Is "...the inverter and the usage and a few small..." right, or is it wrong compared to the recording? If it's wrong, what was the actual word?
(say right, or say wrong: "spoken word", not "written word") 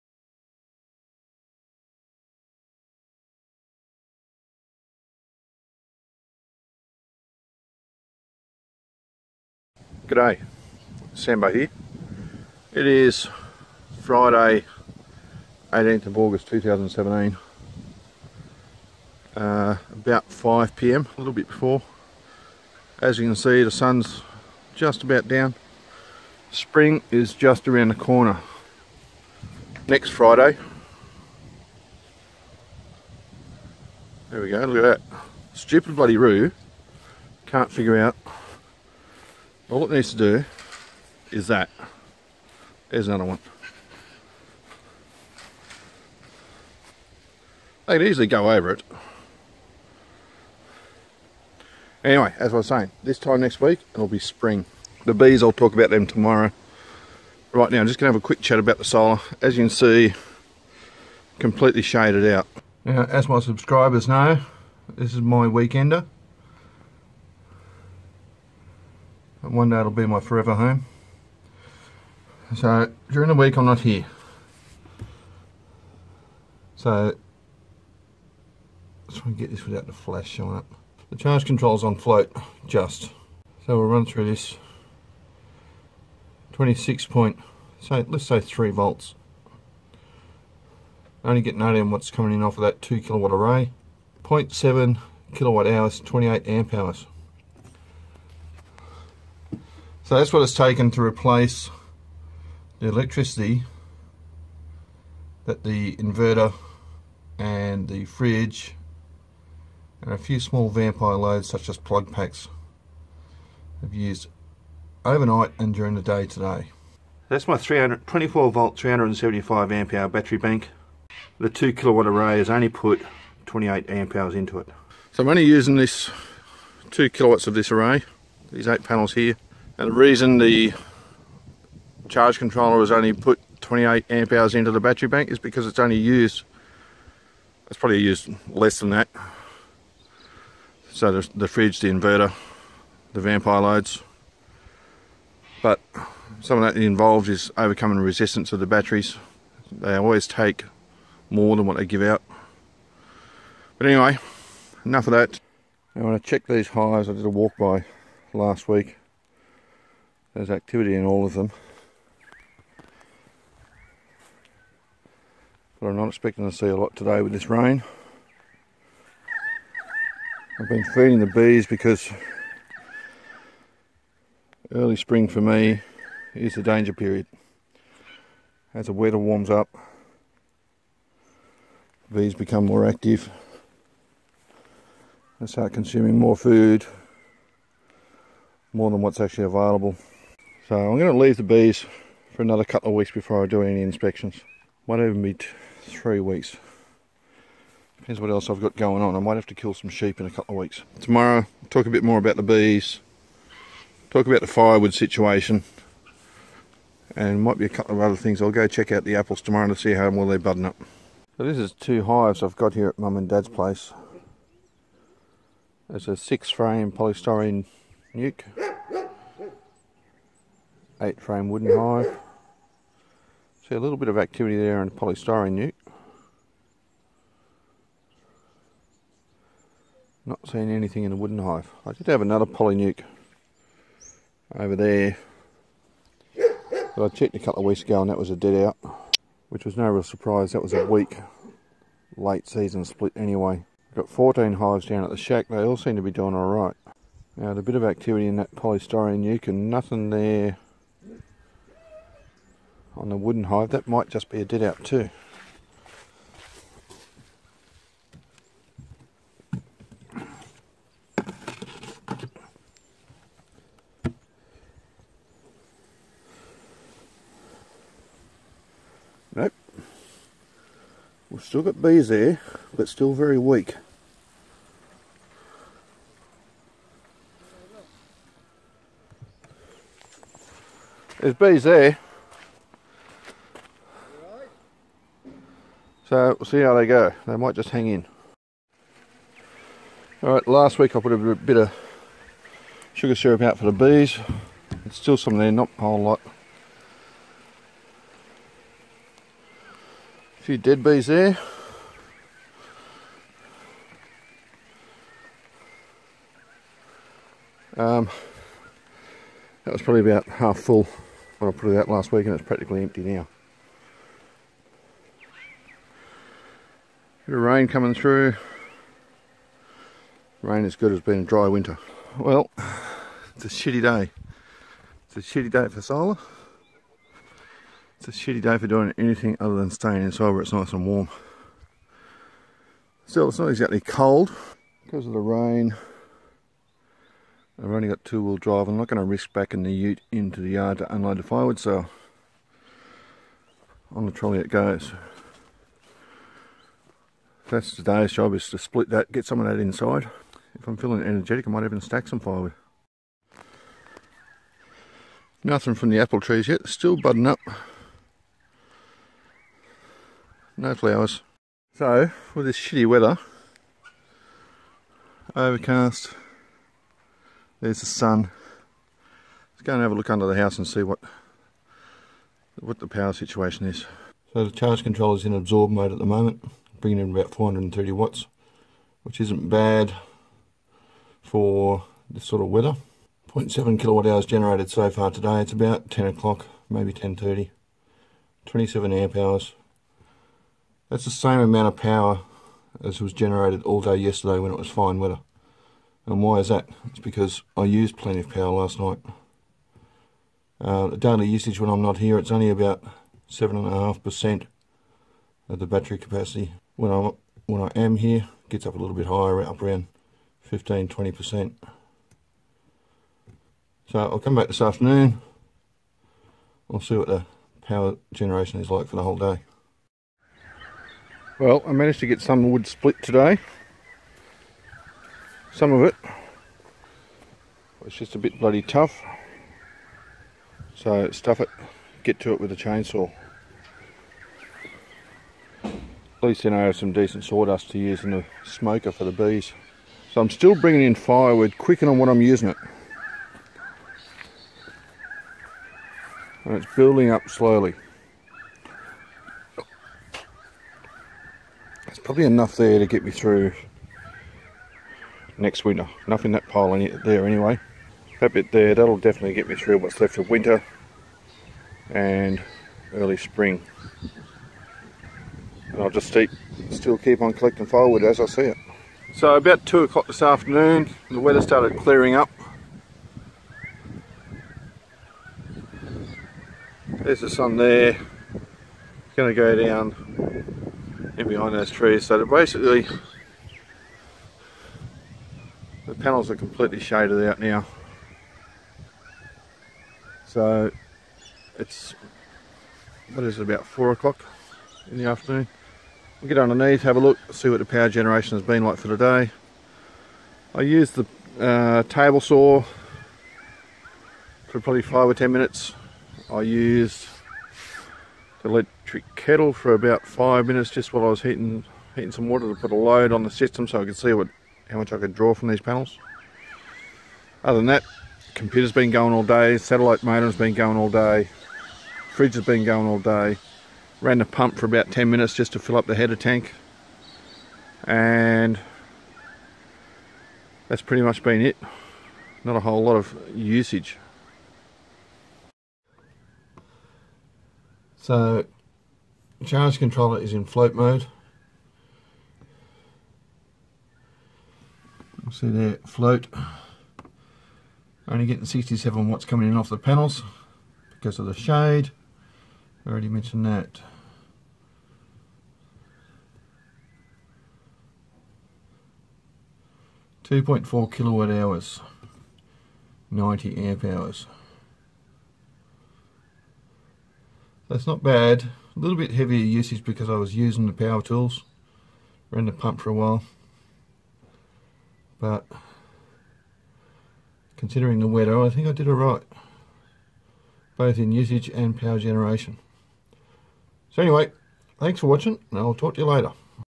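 wrong: "fridge", not "usage".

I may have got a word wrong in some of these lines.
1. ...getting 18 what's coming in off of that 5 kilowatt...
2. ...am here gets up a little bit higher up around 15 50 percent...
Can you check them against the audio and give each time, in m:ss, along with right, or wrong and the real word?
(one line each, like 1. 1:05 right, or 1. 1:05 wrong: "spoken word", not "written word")
1. 1:31 wrong: "2", not "5"
2. 6:47 wrong: "20", not "50".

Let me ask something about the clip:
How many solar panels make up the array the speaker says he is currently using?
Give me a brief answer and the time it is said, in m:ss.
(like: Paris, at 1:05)
8, at 2:08.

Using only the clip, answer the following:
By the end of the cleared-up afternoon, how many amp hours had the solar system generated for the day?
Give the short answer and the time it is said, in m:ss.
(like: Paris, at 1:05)
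90 amp hours, at 9:23.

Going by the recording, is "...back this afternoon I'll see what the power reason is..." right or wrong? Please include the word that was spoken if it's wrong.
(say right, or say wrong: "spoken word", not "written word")
wrong: "generation", not "reason".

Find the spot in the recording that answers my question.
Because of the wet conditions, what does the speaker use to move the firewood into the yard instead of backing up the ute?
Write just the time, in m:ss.
5:44.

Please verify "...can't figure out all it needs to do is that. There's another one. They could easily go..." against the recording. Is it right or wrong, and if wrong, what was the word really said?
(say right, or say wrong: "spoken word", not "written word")
right.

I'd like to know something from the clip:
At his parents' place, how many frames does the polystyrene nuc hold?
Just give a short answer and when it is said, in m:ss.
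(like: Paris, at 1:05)
6, at 3:36.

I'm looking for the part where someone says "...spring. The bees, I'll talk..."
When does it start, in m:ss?
0:54.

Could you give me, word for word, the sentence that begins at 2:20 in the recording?
So the, the fridge, the inverter, the vampire loads.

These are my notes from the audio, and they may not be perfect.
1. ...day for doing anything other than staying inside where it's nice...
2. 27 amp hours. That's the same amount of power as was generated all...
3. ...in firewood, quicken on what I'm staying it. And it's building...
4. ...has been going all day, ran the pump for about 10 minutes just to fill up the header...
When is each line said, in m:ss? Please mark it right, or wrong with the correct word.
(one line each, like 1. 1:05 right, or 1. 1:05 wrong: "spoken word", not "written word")
1. 5:28 right
2. 6:28 right
3. 7:20 wrong: "using", not "staying"
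4. 8:42 right.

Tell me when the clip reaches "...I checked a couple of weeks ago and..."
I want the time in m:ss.
3:57.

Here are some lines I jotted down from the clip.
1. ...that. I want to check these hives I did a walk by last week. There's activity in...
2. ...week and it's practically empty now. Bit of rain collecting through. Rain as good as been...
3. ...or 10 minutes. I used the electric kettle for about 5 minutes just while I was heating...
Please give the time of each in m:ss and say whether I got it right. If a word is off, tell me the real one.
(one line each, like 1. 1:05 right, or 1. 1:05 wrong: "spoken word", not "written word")
1. 2:35 right
2. 5:12 wrong: "coming", not "collecting"
3. 8:25 right.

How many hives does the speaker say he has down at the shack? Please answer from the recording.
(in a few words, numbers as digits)
14.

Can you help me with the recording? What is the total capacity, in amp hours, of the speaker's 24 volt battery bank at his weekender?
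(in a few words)
375 amp hours.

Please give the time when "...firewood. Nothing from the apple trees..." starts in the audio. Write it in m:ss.
5:52.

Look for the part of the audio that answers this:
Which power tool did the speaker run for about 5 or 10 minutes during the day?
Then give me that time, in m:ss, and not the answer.
8:21.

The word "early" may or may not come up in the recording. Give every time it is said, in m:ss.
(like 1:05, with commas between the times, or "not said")
2:54, 7:42.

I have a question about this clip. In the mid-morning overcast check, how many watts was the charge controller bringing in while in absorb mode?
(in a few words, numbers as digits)
430 watts.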